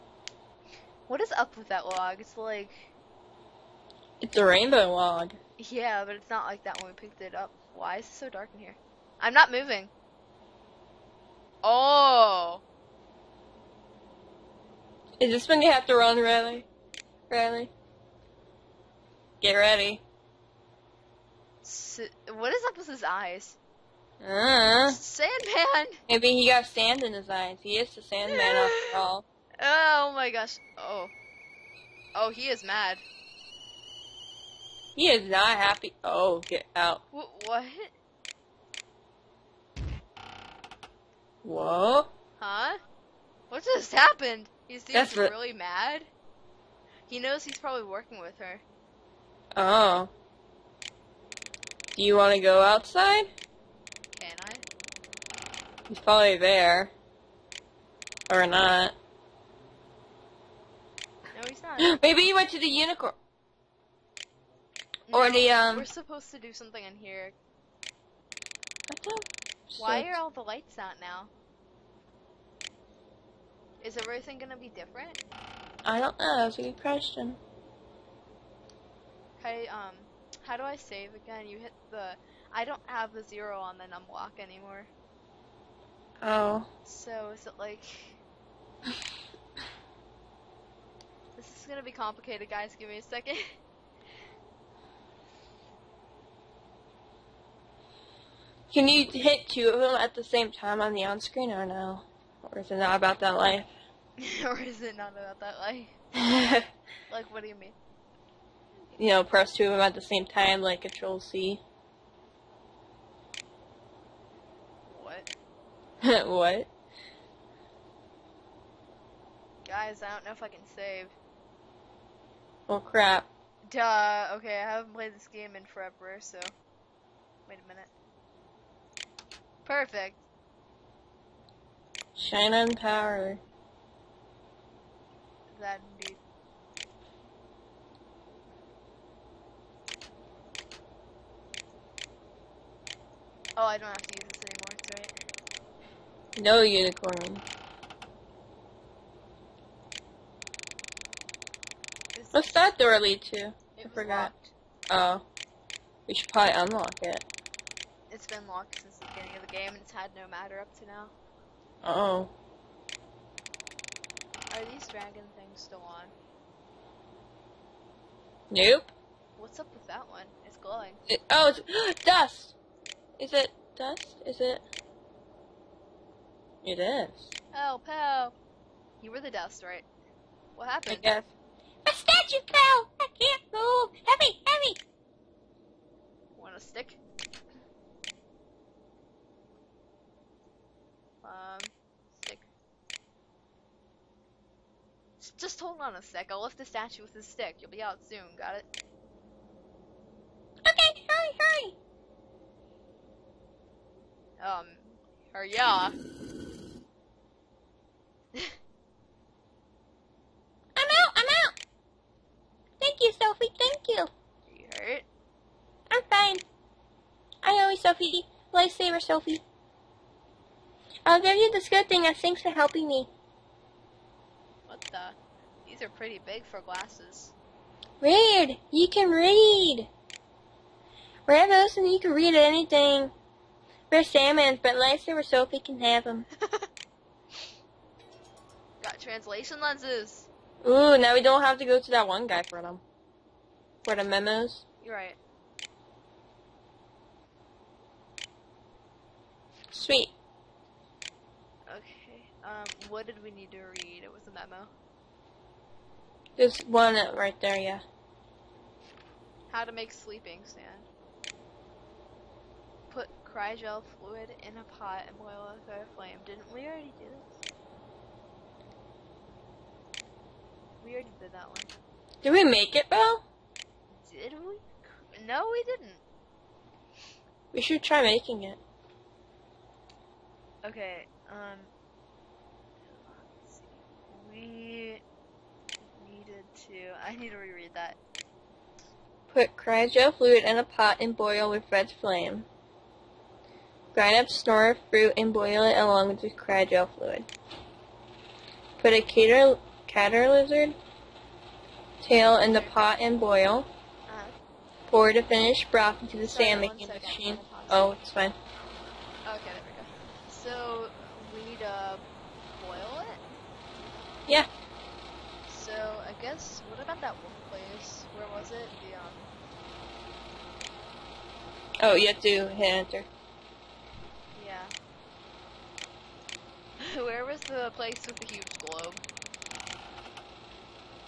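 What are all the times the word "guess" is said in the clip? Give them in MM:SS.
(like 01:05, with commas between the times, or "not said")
03:01, 05:16.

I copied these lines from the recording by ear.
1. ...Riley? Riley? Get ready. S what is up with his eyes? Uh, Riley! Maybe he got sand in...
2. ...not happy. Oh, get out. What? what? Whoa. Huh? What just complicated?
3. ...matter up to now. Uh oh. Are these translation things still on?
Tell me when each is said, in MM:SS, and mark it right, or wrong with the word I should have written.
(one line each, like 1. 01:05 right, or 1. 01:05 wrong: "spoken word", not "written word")
1. 00:16 wrong: "Sandman", not "Riley"
2. 00:35 wrong: "happened", not "complicated"
3. 02:40 wrong: "dragon", not "translation".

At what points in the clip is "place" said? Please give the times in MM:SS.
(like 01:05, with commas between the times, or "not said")
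05:17, 05:27.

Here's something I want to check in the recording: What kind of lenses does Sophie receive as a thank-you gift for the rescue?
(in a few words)
translation lenses.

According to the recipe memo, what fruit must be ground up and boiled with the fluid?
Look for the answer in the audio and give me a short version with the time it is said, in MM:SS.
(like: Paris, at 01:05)
snorer fruit, at 04:54.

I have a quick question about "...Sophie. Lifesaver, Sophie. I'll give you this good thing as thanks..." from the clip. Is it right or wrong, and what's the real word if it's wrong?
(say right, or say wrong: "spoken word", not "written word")
right.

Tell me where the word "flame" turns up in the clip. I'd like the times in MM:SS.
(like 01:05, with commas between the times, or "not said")
04:25, 04:52.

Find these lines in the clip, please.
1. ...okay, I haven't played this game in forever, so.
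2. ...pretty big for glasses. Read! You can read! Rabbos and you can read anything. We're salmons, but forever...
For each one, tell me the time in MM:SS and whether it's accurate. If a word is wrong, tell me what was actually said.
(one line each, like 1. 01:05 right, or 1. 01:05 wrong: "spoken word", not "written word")
1. 02:04 right
2. 03:45 wrong: "nicer", not "forever".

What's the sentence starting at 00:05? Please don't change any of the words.
Yeah, but it's not like that when we picked it up.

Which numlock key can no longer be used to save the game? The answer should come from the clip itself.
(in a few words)
zero.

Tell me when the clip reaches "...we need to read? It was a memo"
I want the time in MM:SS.
04:13.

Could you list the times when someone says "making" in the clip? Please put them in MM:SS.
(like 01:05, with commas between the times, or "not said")
04:38, 05:06.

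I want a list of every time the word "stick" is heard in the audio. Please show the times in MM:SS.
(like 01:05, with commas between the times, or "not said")
03:06, 03:12, 03:17.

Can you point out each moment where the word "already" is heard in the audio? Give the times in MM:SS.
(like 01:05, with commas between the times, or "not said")
04:26, 04:30.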